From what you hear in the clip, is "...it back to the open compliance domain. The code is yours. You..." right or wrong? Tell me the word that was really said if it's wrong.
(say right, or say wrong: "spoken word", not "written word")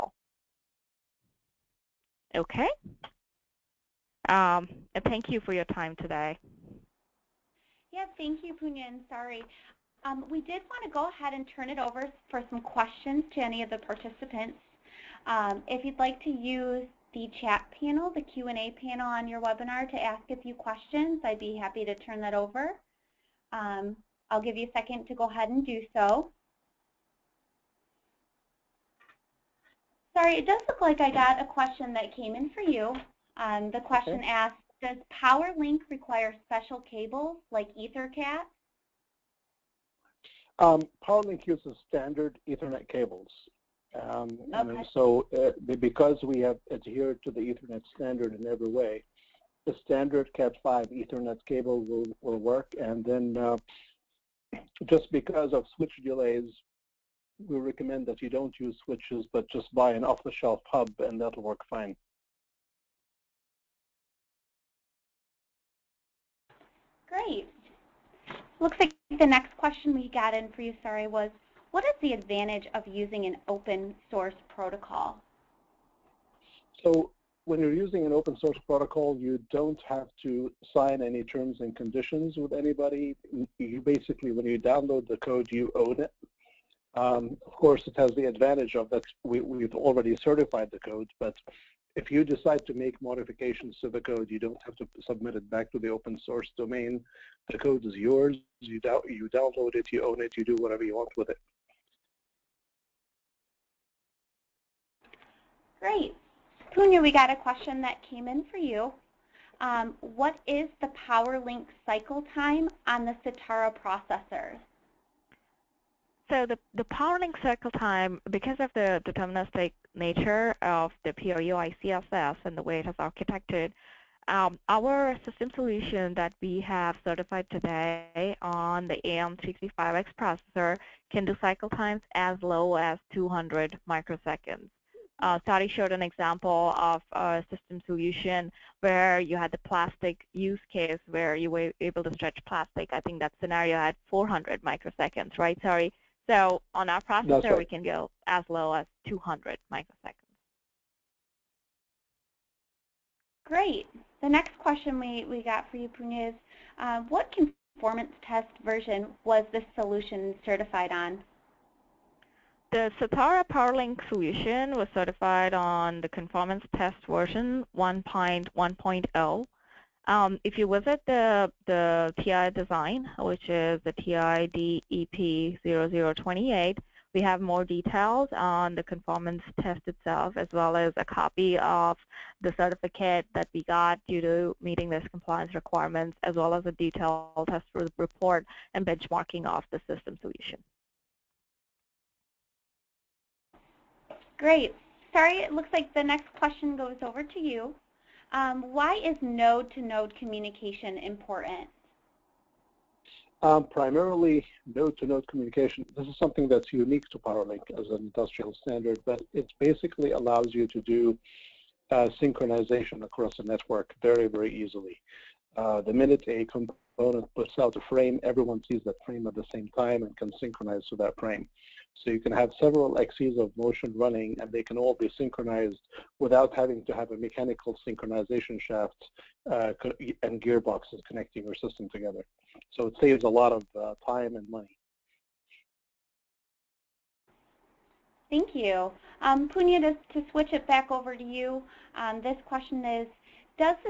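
wrong: "source", not "compliance".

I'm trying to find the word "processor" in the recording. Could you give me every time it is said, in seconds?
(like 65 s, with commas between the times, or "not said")
113 s, 130 s, 147 s.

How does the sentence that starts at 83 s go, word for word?
You basically, when you download the code, you own it.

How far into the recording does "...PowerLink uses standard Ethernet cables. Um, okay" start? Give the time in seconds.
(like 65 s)
41 s.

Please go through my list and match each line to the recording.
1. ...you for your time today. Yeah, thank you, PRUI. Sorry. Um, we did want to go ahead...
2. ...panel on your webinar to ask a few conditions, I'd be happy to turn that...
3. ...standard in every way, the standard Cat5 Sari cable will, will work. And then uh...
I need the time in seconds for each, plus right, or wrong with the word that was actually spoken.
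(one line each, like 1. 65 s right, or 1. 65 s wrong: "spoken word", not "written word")
1. 5 s wrong: "Punyan", not "PRUI"
2. 18 s wrong: "questions", not "conditions"
3. 47 s wrong: "Ethernet", not "Sari".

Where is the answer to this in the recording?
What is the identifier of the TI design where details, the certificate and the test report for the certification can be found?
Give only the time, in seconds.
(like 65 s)
173 s.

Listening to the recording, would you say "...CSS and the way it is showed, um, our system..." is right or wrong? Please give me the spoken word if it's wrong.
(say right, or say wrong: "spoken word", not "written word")
wrong: "architected", not "showed".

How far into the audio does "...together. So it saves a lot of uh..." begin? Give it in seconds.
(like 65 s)
231 s.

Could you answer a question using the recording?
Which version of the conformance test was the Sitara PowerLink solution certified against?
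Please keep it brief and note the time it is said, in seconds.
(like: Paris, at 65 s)
1.1.0, at 167 s.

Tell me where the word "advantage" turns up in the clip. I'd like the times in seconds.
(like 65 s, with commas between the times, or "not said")
72 s, 88 s.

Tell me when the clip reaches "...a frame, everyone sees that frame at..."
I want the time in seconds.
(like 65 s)
217 s.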